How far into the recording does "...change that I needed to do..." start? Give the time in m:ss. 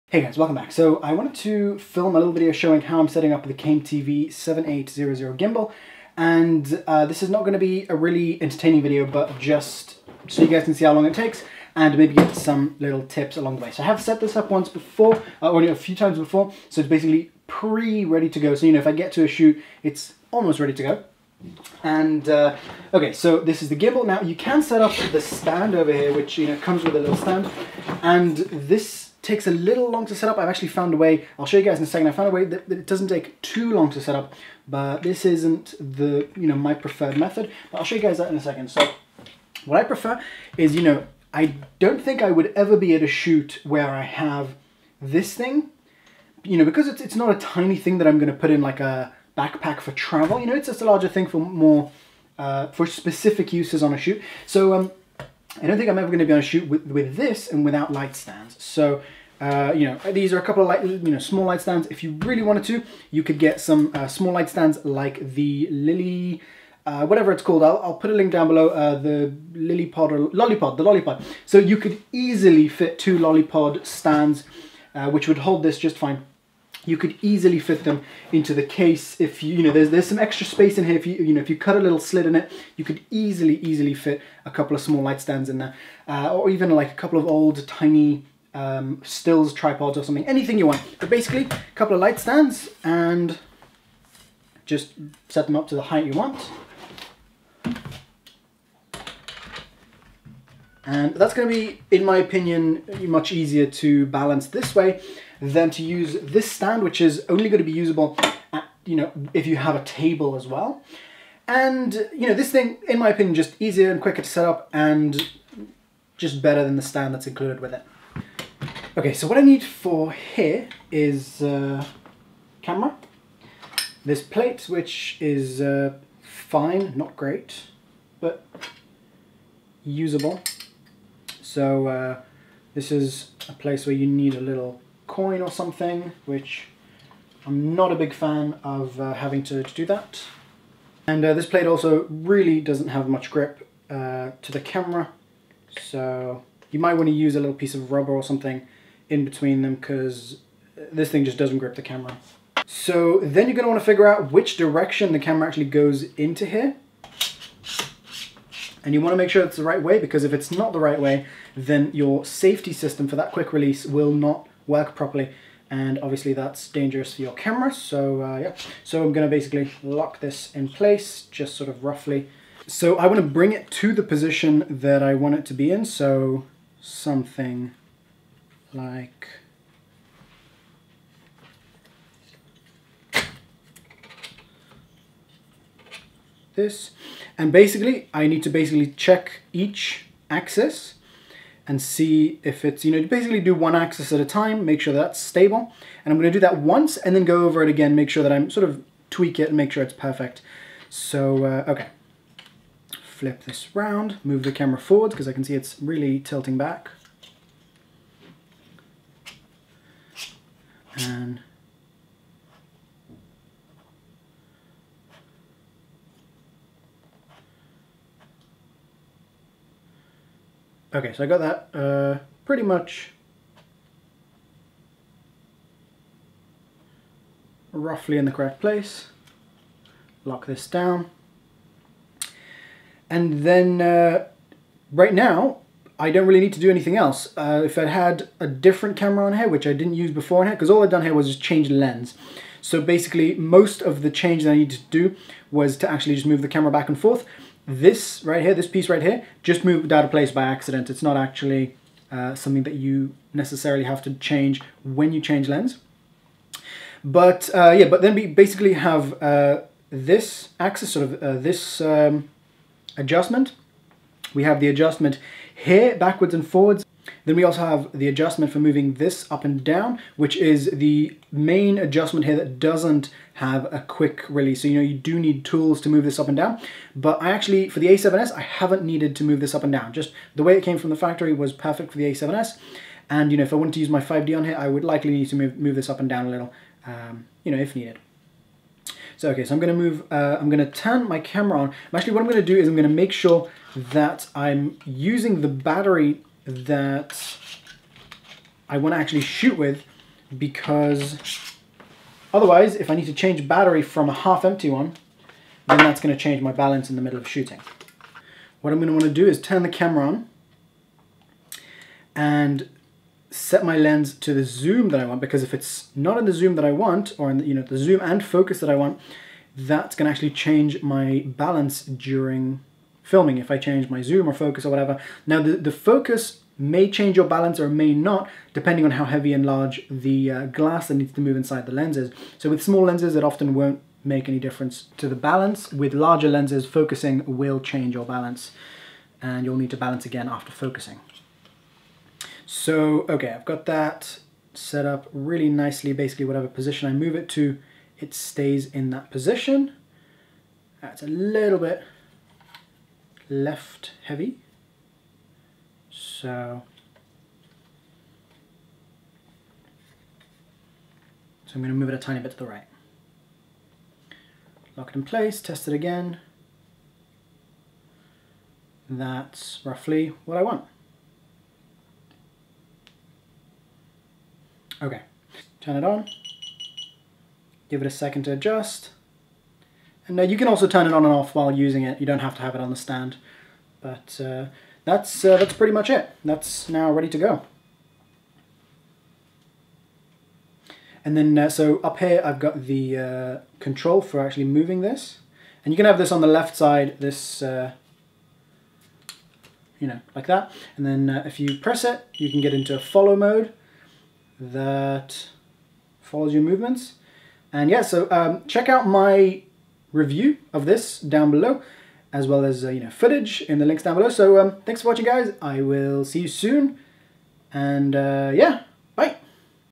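4:04.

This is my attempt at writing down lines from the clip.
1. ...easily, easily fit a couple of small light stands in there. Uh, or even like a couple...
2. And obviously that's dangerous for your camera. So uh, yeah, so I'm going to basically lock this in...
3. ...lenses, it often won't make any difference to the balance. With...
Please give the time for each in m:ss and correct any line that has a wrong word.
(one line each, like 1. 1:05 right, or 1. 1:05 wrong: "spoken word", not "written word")
1. 1:23 right
2. 2:45 right
3. 5:32 right.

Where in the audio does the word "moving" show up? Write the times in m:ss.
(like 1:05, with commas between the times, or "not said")
4:28, 6:34.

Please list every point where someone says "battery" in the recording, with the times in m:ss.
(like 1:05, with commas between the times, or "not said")
4:55, 5:03.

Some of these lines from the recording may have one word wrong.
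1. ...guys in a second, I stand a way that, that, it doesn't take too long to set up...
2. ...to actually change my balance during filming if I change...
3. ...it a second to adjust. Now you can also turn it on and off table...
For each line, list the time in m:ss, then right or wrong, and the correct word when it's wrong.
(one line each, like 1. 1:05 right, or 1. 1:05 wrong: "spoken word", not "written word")
1. 0:31 wrong: "found", not "stand"
2. 5:20 right
3. 6:17 wrong: "while", not "table".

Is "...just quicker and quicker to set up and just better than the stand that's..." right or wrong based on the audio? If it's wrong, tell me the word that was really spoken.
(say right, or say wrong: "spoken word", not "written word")
wrong: "easier", not "quicker".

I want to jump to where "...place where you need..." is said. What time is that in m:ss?
2:13.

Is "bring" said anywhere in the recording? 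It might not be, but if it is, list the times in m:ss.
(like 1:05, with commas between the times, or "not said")
2:53.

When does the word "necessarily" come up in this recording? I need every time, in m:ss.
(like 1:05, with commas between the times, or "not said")
4:13.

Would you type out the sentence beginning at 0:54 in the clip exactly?
So, um, I don't think I'm ever going to be able to shoot with, with this and without light stands.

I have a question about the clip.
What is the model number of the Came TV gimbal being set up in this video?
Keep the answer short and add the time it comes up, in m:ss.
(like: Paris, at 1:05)
7800, at 0:04.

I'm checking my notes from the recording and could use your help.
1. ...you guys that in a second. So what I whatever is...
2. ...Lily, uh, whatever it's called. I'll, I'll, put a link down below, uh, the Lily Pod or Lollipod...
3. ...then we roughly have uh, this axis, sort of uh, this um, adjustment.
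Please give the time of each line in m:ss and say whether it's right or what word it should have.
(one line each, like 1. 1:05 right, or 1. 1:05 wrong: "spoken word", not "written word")
1. 0:37 wrong: "prefer", not "whatever"
2. 1:05 right
3. 4:18 wrong: "basically", not "roughly".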